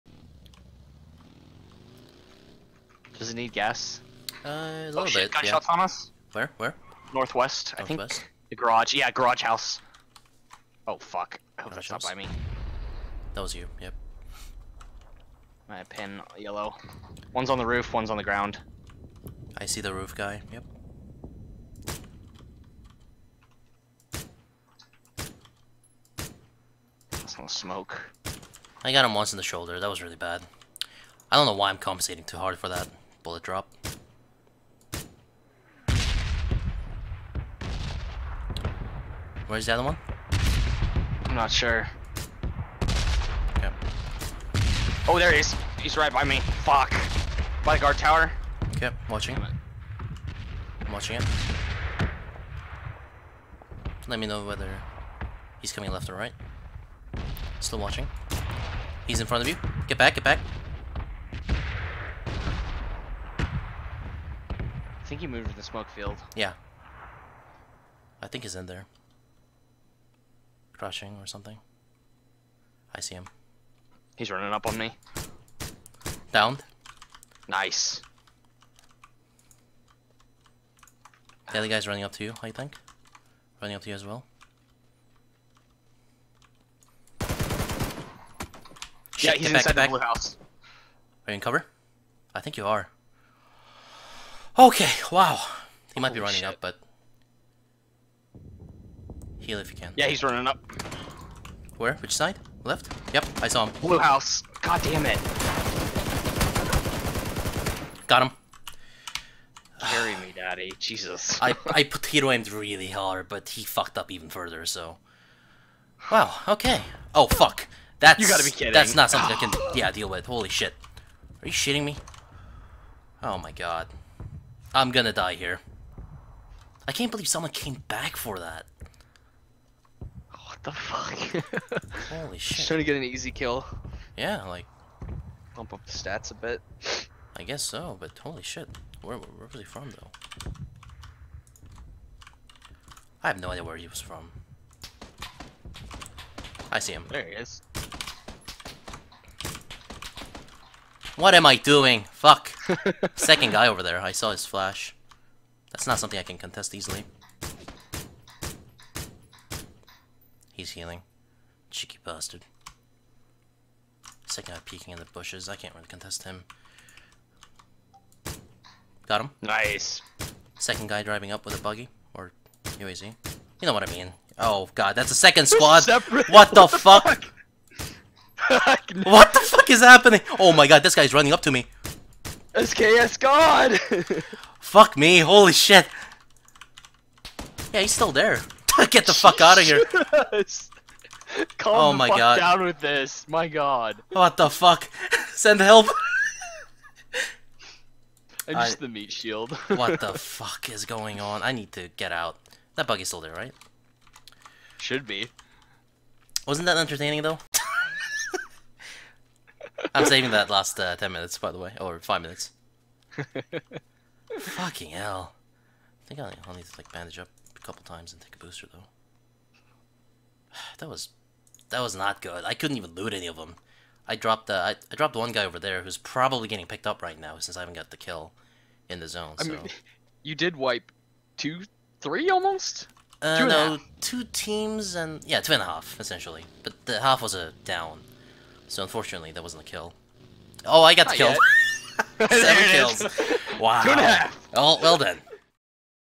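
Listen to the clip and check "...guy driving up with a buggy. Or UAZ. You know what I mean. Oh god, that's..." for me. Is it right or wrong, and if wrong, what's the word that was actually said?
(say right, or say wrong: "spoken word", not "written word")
right.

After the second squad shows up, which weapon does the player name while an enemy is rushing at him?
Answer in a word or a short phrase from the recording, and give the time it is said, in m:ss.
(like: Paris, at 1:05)
SKS, at 3:02.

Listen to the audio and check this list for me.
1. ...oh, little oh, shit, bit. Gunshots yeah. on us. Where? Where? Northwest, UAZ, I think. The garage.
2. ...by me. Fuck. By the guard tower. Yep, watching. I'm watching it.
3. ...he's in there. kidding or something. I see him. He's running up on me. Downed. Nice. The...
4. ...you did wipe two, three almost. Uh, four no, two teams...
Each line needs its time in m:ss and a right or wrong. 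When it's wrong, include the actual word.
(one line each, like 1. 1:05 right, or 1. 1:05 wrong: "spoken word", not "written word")
1. 0:04 wrong: "Northwest", not "UAZ"
2. 0:46 right
3. 1:08 wrong: "crushing", not "kidding"
4. 3:50 wrong: "two", not "four".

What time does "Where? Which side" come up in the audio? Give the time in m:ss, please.
1:41.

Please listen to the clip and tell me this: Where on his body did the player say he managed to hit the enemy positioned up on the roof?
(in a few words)
Shoulder.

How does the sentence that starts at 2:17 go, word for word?
I guess so, but holy shit.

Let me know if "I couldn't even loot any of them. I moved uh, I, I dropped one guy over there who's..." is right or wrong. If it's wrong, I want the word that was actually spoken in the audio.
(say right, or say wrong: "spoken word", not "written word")
wrong: "dropped", not "moved".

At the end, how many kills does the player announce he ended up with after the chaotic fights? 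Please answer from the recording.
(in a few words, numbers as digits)
7.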